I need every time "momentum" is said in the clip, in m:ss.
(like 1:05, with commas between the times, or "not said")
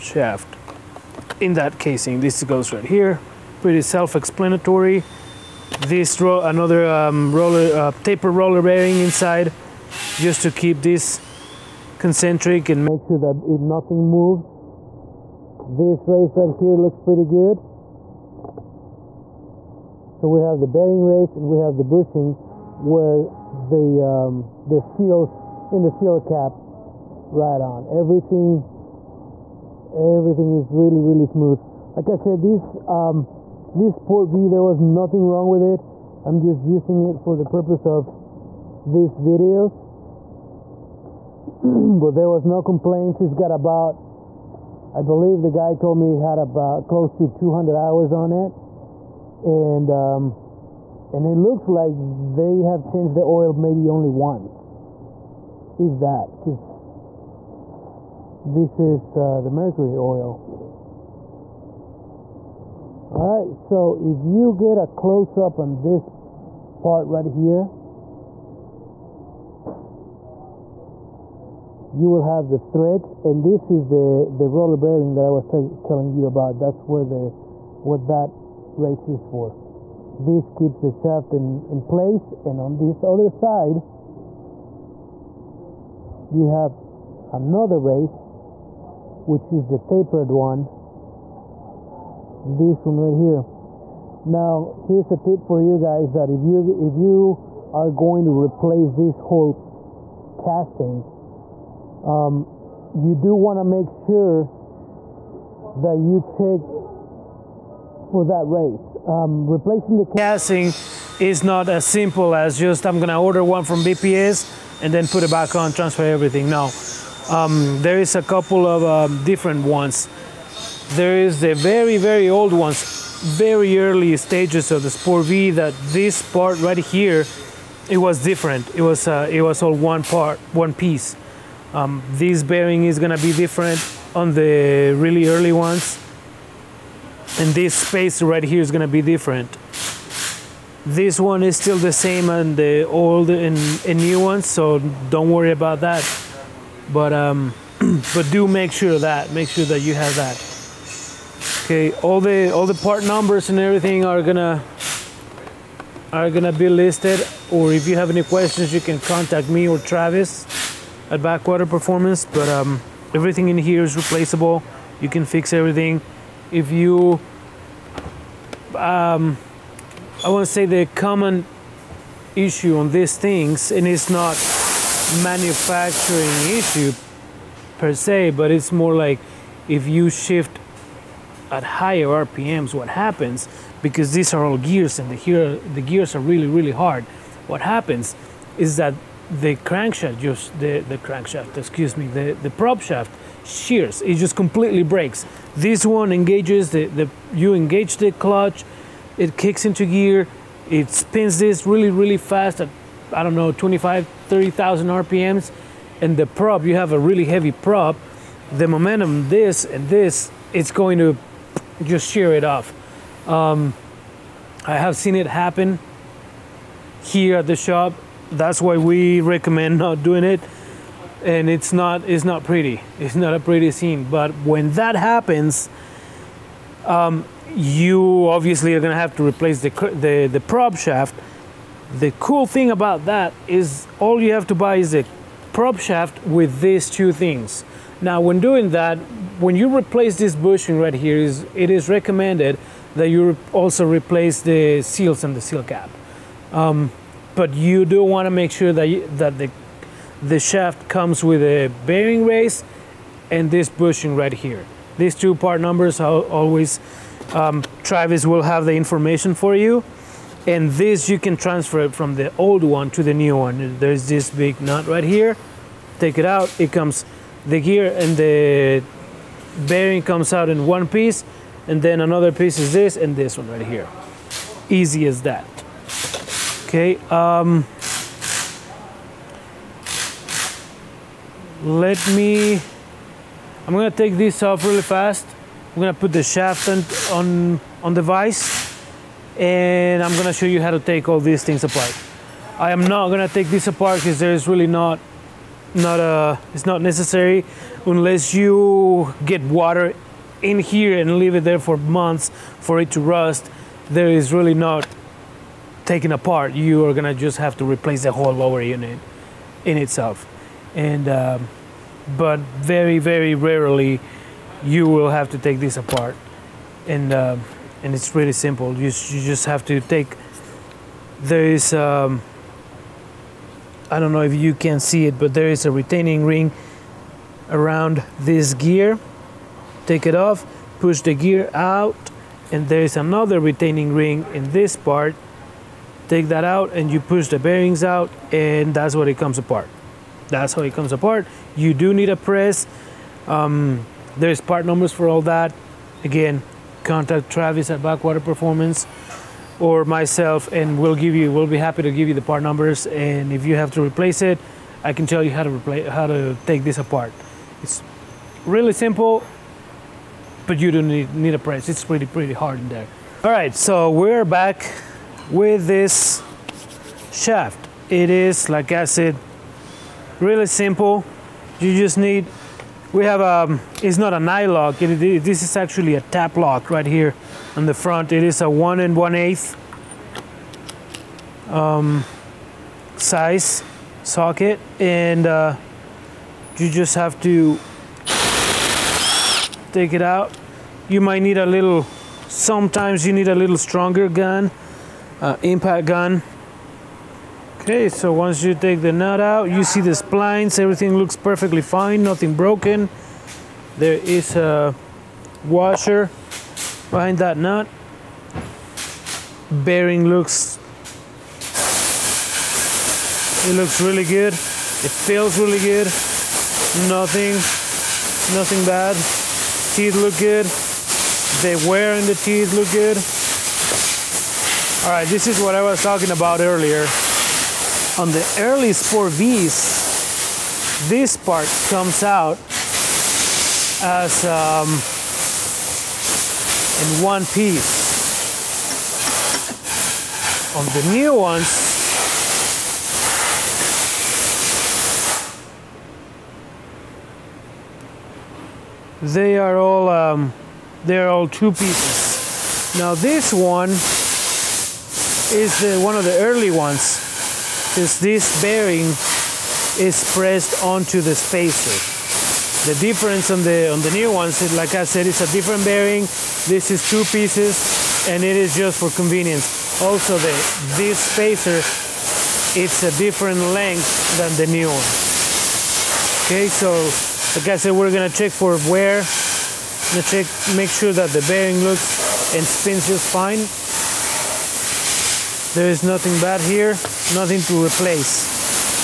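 3:28.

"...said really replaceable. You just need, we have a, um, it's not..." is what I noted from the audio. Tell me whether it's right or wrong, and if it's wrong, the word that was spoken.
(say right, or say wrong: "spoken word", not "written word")
wrong: "simple", not "replaceable".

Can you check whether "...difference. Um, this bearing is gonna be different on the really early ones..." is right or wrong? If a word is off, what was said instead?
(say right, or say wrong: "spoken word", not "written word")
wrong: "piece", not "difference".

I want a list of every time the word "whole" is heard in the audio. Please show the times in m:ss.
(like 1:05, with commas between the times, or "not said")
1:39, 5:08.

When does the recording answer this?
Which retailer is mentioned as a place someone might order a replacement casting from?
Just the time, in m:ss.
1:53.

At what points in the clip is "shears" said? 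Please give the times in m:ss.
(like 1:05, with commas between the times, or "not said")
3:13, 3:32.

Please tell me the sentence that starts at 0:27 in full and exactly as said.
Everything, everything is really, really smooth.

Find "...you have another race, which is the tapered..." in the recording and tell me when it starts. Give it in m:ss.
1:26.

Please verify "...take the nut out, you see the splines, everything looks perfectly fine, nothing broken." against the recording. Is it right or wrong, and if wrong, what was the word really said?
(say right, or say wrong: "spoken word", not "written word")
right.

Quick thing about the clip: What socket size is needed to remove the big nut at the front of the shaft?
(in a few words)
1 1/8.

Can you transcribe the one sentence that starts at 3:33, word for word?
Um, I have seen it happen here at the shop.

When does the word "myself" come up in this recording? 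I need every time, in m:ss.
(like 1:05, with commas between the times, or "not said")
5:49.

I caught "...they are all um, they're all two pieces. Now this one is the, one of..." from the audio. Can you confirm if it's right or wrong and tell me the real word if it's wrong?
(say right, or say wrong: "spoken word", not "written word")
right.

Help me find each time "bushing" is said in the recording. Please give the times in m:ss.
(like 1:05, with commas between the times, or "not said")
0:21, 4:00, 4:13.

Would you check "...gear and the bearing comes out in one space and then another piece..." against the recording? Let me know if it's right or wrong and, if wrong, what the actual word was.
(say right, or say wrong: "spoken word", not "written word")
wrong: "piece", not "space".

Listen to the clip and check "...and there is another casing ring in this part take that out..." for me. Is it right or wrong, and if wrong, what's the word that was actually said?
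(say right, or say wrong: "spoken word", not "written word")
wrong: "retaining", not "casing".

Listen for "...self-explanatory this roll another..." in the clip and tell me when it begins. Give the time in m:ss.
0:03.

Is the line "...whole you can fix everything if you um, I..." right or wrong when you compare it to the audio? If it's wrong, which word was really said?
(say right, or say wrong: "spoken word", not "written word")
wrong: "replaceable", not "whole".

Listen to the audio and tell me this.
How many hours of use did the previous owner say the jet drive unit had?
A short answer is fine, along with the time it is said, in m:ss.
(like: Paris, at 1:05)
200, at 0:47.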